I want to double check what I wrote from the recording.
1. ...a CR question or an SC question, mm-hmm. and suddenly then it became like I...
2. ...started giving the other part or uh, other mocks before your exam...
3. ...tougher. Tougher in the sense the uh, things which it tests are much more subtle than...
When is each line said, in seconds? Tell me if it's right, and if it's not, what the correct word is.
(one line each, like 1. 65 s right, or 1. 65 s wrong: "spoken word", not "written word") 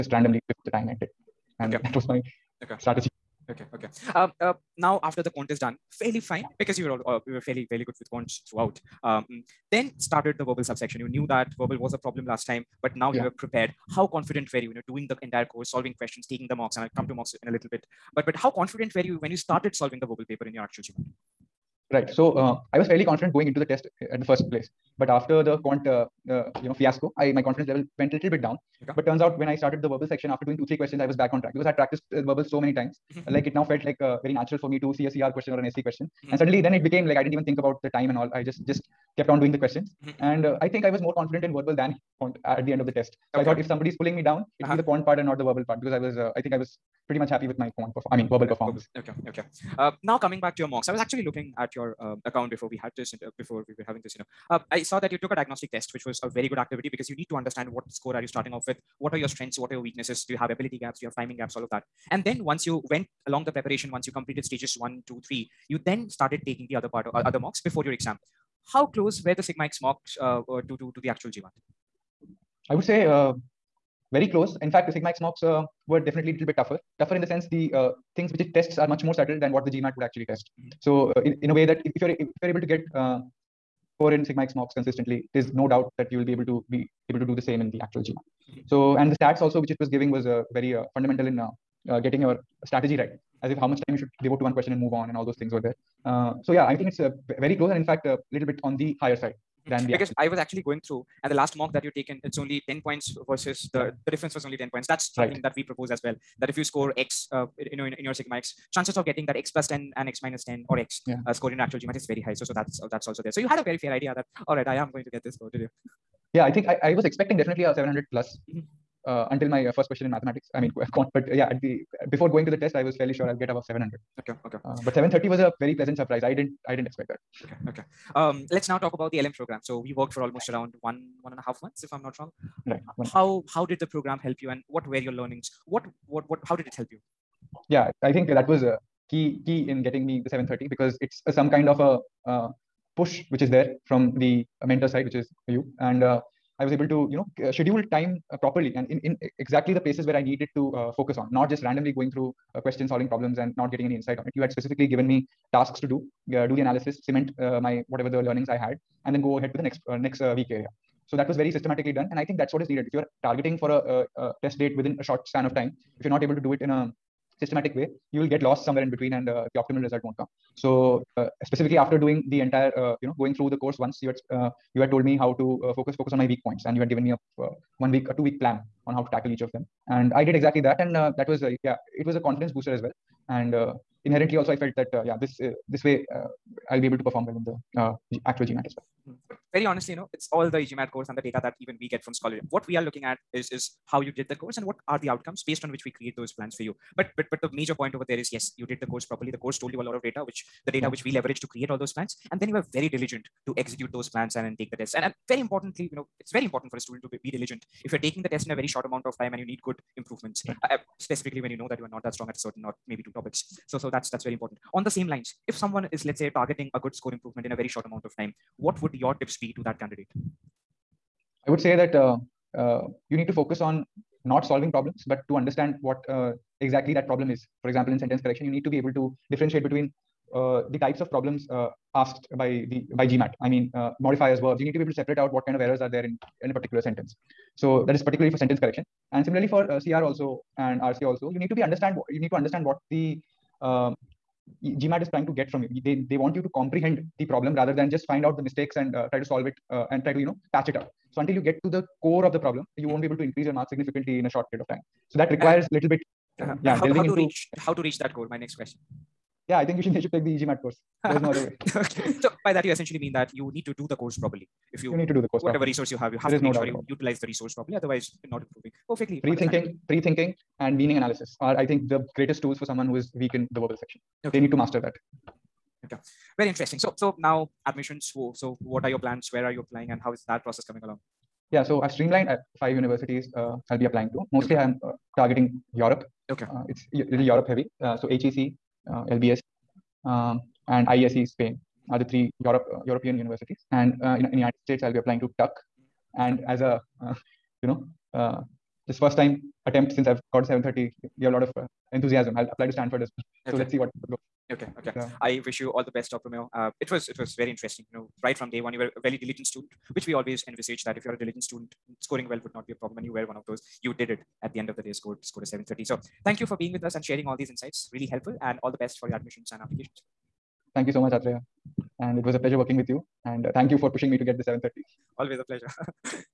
1. 35 s right
2. 66 s wrong: "taking", not "giving"
3. 76 s right.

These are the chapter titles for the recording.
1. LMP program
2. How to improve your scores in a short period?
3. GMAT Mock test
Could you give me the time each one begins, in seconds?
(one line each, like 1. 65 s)
1. 128 s
2. 219 s
3. 50 s.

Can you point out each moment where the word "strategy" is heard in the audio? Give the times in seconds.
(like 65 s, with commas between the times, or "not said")
2 s, 92 s.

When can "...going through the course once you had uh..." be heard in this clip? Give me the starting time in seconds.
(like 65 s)
173 s.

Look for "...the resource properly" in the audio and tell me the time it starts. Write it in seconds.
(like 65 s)
267 s.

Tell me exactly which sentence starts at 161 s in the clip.
So that was very systematically done, and I think that's what is needed.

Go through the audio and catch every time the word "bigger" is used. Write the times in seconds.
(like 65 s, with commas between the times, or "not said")
not said.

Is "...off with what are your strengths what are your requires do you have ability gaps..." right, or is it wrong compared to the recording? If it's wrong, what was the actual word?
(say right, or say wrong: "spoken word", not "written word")
wrong: "weaknesses", not "requires".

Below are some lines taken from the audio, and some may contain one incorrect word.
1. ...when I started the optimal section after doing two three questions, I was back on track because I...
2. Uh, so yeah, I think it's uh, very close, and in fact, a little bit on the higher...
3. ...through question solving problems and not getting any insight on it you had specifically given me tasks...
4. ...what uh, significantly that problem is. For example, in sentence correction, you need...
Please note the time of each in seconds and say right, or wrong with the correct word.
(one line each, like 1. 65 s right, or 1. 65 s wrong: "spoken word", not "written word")
1. 29 s wrong: "verbal", not "optimal"
2. 96 s right
3. 152 s right
4. 225 s wrong: "exactly", not "significantly".